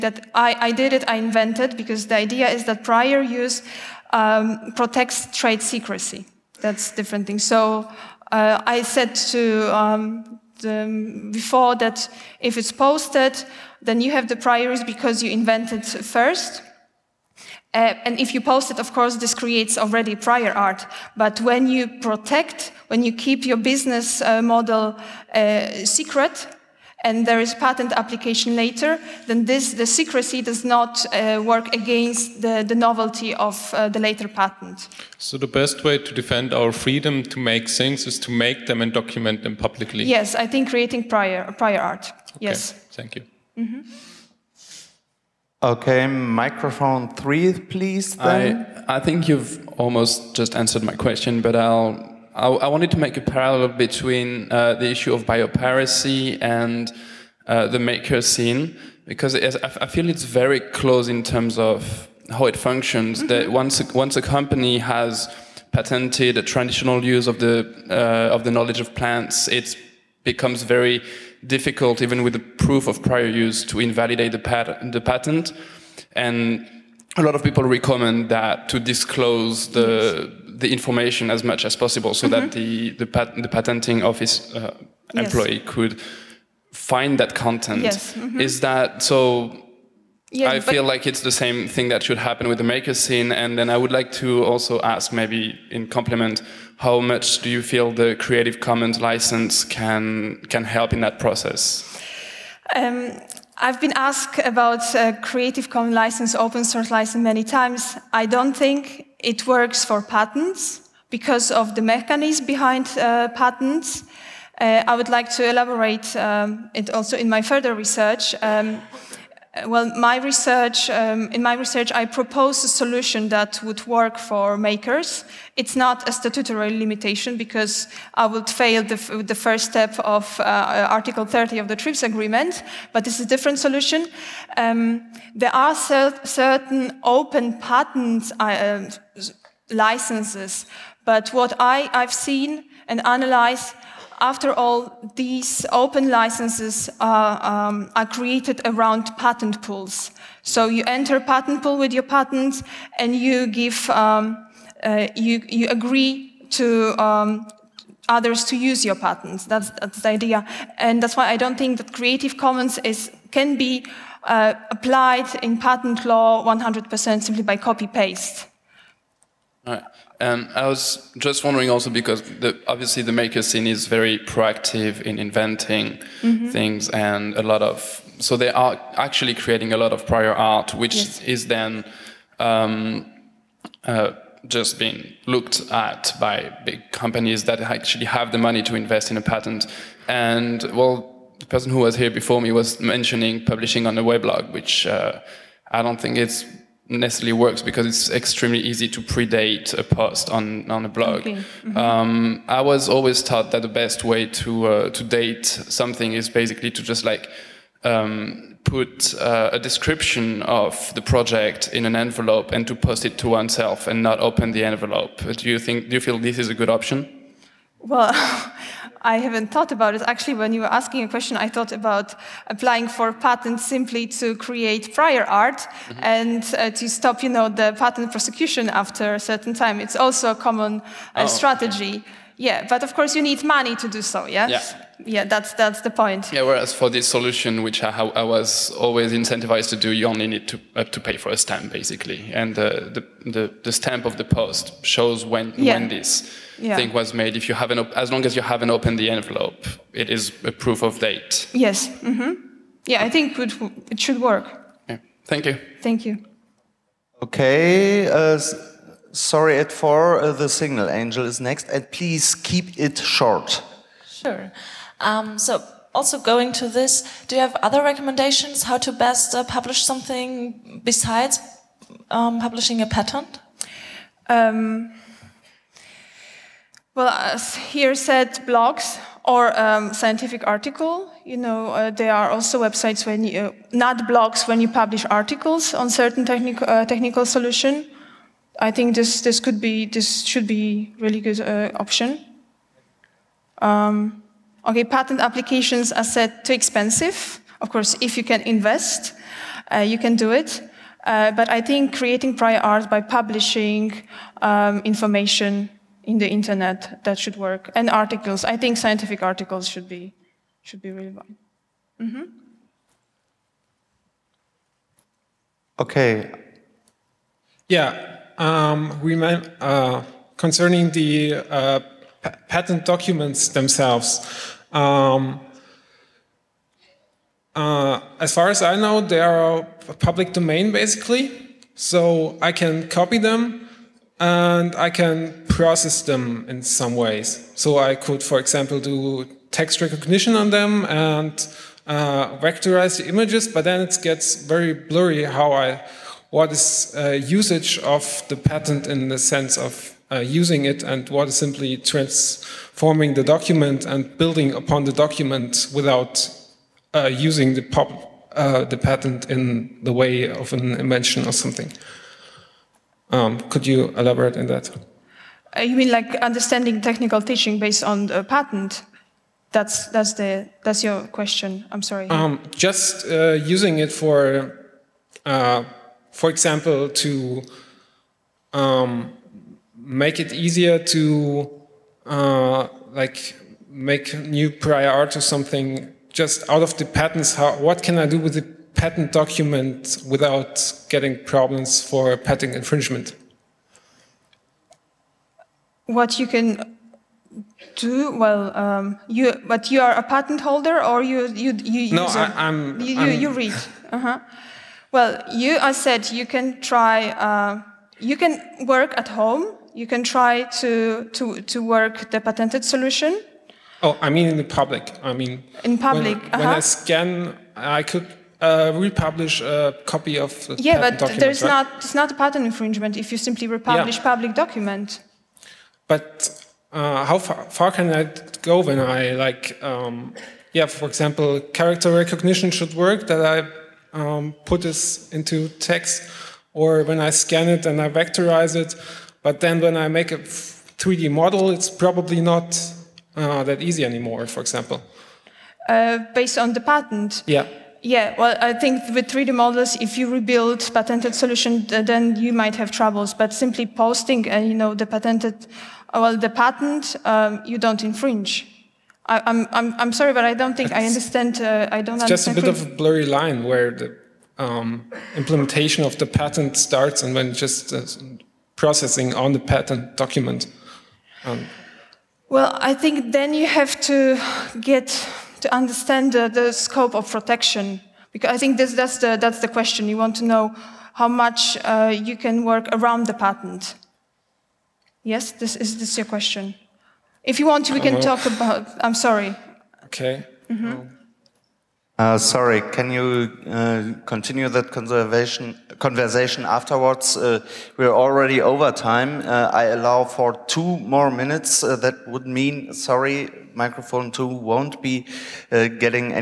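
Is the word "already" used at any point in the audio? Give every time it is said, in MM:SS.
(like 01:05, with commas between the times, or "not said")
00:19, 08:17.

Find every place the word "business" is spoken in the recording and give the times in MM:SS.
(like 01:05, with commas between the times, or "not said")
00:23.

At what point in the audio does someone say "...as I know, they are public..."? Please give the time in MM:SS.
05:28.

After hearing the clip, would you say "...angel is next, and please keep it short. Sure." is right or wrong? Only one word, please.
right.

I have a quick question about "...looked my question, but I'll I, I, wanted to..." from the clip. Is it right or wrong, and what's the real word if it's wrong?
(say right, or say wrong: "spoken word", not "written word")
wrong: "answered", not "looked".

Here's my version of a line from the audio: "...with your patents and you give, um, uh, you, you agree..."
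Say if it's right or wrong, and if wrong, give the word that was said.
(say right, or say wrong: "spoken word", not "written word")
right.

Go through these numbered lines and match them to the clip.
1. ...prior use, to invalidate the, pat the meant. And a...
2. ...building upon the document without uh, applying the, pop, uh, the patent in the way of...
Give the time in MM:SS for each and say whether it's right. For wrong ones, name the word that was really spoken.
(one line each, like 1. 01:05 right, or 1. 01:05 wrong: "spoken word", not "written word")
1. 01:13 wrong: "patent", not "meant"
2. 05:54 wrong: "using", not "applying".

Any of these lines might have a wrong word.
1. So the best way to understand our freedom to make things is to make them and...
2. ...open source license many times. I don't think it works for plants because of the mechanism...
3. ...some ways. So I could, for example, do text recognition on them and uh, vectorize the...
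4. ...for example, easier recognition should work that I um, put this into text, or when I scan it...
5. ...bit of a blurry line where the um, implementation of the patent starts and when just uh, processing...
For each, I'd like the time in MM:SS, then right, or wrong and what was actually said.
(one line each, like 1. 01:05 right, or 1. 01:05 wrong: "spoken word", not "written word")
1. 00:35 wrong: "defend", not "understand"
2. 01:46 wrong: "patents", not "plants"
3. 05:36 right
4. 07:10 wrong: "character", not "easier"
5. 07:42 right.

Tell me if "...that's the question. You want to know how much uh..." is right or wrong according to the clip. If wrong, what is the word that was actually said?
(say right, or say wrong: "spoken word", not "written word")
right.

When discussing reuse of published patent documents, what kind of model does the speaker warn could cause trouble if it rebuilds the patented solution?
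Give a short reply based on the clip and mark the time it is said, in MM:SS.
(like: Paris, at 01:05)
3D models, at 07:29.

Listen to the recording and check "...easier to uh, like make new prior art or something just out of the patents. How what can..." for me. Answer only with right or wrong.
right.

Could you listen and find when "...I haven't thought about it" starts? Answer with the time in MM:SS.
03:39.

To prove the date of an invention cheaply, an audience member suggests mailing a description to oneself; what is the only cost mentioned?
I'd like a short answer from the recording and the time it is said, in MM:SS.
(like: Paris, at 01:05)
a stamp, at 04:01.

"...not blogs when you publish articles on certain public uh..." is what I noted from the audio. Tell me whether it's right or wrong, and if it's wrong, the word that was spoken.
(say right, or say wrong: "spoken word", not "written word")
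wrong: "technic", not "public".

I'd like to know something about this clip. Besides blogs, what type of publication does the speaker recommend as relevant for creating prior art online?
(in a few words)
scientific articles.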